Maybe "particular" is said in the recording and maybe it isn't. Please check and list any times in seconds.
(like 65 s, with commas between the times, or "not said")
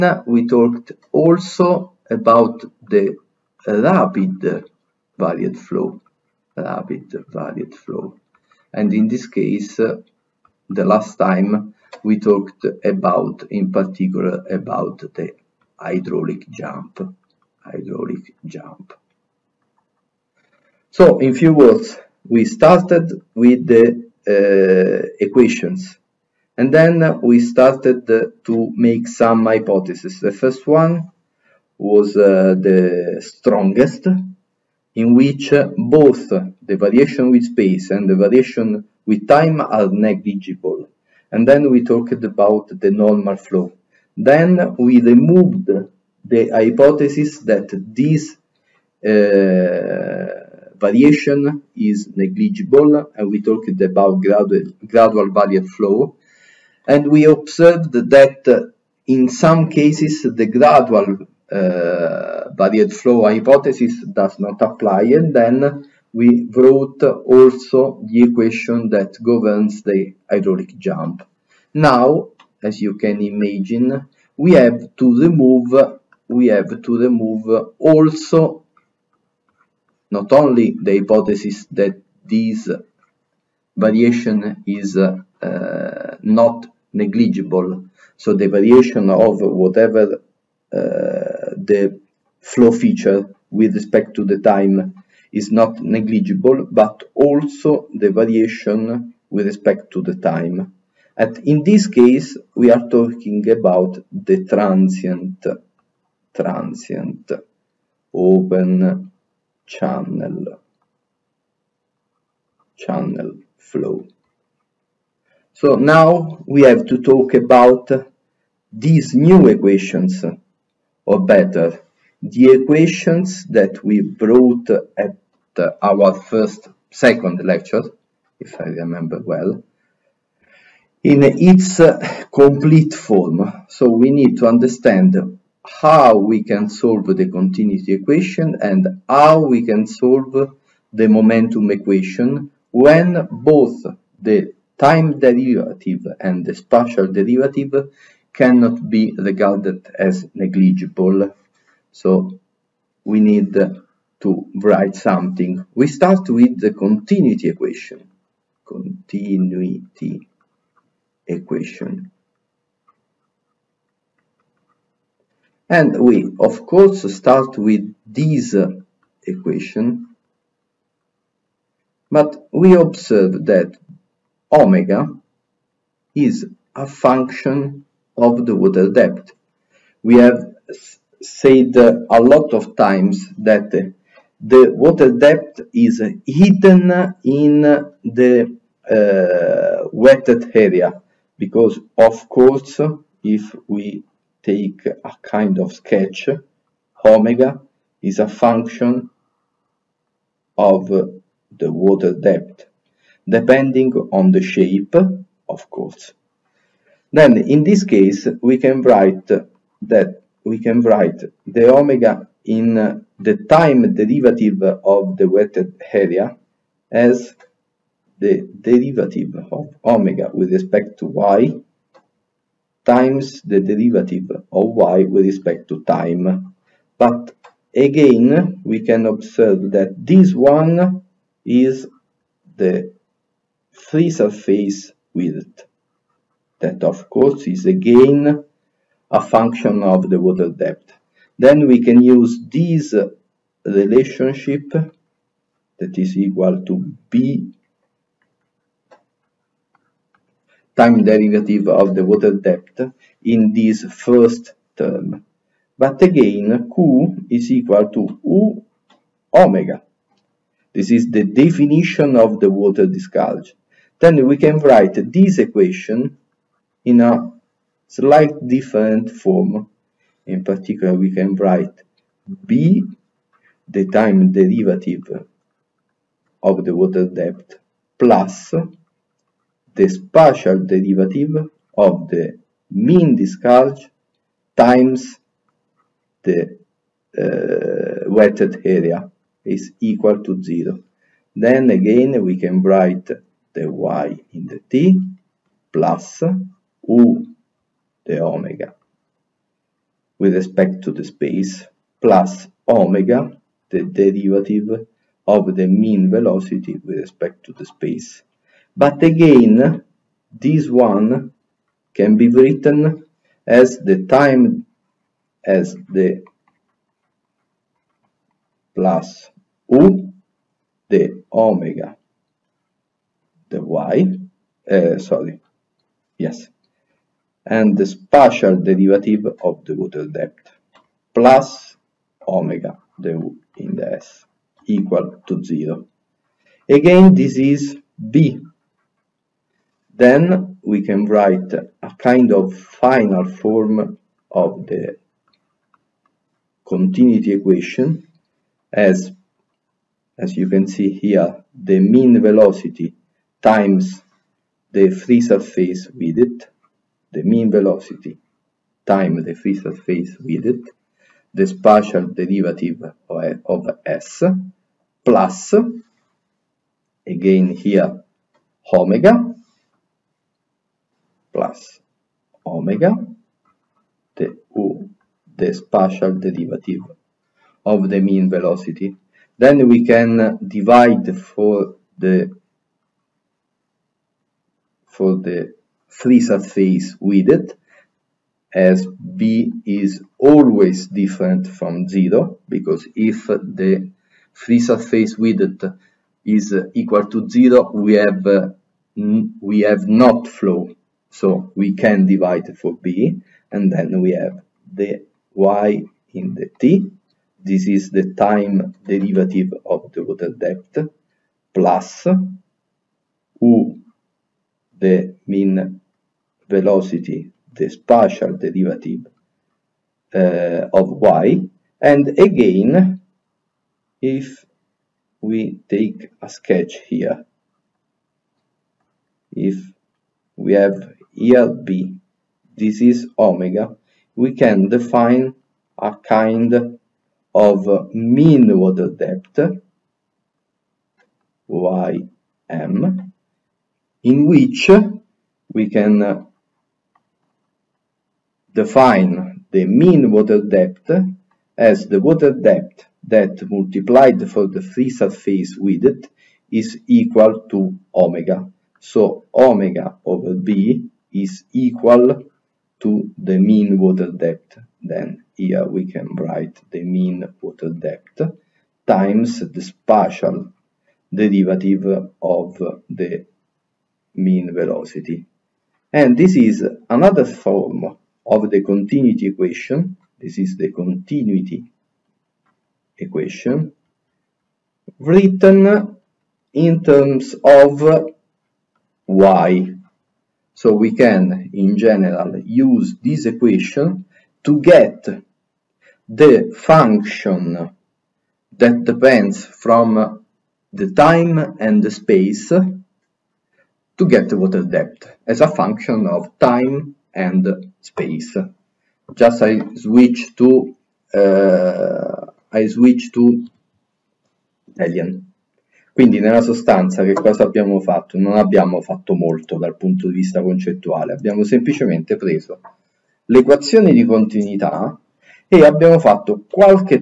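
13 s, 270 s.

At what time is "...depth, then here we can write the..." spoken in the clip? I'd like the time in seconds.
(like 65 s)
464 s.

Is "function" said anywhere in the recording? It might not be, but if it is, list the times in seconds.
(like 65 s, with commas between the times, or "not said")
176 s, 198 s, 239 s, 496 s, 505 s.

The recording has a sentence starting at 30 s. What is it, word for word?
The first one was uh, the strongest, in which uh, both the variation with space and the variation with time are negligible.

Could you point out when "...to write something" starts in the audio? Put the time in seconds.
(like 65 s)
153 s.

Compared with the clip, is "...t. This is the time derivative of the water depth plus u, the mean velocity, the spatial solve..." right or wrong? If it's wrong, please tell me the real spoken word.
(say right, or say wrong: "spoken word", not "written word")
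wrong: "derivative", not "solve".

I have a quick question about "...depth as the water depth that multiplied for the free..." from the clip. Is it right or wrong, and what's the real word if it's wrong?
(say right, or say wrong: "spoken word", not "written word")
right.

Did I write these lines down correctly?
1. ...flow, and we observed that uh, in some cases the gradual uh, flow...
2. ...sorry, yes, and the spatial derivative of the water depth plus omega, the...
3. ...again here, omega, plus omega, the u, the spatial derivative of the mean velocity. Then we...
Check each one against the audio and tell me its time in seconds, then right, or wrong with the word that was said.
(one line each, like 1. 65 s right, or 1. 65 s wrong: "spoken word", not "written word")
1. 55 s right
2. 324 s right
3. 367 s right.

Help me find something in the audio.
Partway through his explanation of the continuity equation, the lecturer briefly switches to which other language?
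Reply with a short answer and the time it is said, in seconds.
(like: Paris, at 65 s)
Italian, at 514 s.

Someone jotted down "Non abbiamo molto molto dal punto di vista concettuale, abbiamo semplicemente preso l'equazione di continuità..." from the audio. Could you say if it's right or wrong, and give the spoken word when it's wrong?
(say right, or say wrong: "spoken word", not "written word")
wrong: "fatto", not "molto".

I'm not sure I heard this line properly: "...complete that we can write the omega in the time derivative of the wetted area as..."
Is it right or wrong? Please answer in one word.
wrong.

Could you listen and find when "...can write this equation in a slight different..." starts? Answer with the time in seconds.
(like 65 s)
264 s.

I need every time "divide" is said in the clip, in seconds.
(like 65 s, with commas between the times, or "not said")
380 s, 402 s.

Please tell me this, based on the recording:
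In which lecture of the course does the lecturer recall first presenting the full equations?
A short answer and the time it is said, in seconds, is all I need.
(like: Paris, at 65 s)
second lecture, at 126 s.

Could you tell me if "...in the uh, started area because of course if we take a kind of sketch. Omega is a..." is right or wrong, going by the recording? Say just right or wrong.
wrong.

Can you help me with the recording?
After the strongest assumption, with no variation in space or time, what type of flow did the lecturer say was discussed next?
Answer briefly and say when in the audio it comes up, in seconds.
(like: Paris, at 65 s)
normal flow, at 42 s.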